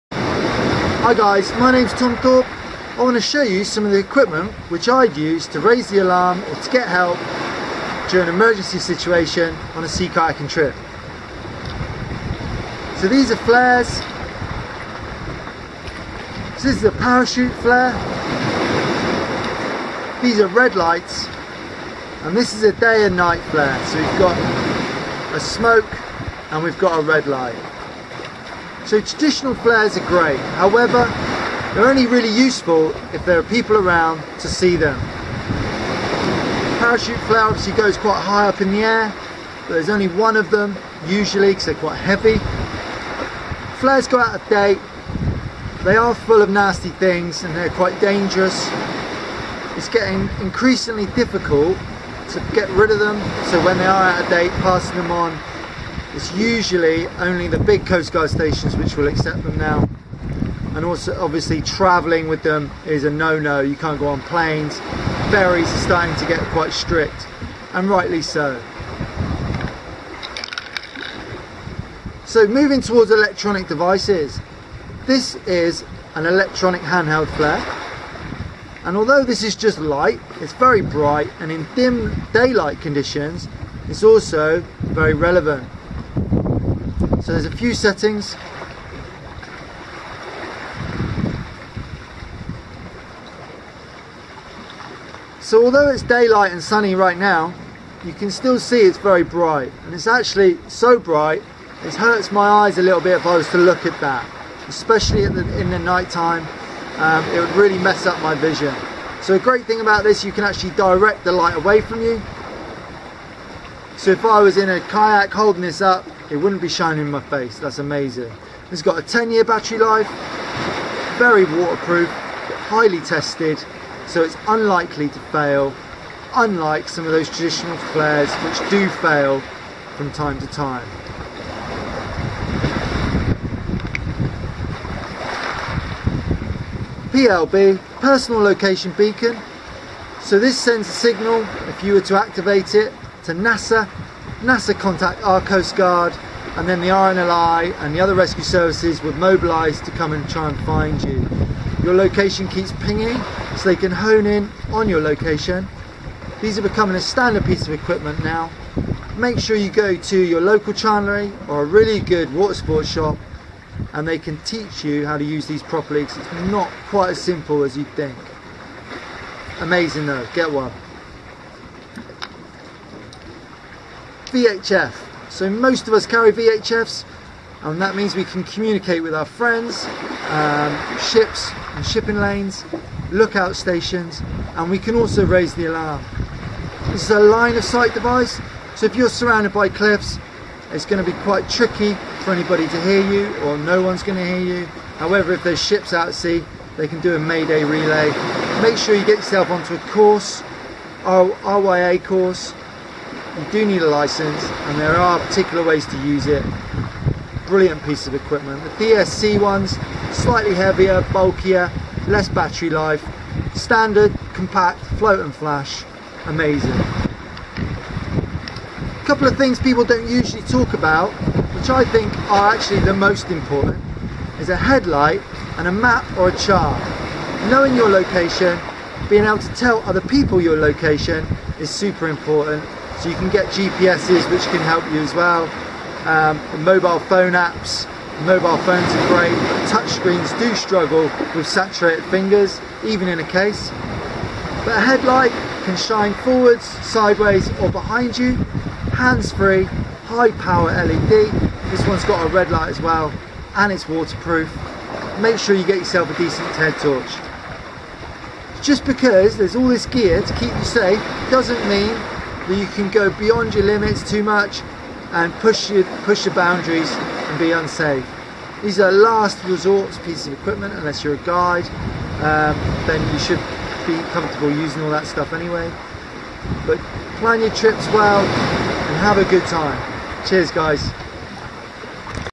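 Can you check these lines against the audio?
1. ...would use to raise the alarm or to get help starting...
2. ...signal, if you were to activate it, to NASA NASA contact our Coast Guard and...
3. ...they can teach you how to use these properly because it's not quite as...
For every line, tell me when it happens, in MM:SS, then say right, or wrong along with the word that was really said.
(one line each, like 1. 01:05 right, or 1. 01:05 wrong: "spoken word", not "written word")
1. 00:05 wrong: "during", not "starting"
2. 02:20 right
3. 02:44 right.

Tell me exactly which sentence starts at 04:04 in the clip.
But a headlight can shine forwards, sideways or behind you, hands-free, high power LED.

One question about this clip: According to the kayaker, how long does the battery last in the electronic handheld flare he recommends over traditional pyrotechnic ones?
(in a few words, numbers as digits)
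10 years.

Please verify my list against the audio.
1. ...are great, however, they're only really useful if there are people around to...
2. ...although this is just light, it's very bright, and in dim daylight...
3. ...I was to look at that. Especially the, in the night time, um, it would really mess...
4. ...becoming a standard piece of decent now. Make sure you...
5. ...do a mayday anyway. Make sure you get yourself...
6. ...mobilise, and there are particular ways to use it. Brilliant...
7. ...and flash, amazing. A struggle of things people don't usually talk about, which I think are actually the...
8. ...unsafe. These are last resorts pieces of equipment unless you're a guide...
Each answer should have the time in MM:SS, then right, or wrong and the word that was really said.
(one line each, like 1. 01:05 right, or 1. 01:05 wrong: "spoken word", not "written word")
1. 00:29 right
2. 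01:18 right
3. 01:43 right
4. 02:36 wrong: "equipment", not "decent"
5. 03:17 wrong: "relay", not "anyway"
6. 03:23 wrong: "license", not "mobilise"
7. 03:35 wrong: "couple", not "struggle"
8. 04:27 right.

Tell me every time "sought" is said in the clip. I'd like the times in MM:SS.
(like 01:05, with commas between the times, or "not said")
not said.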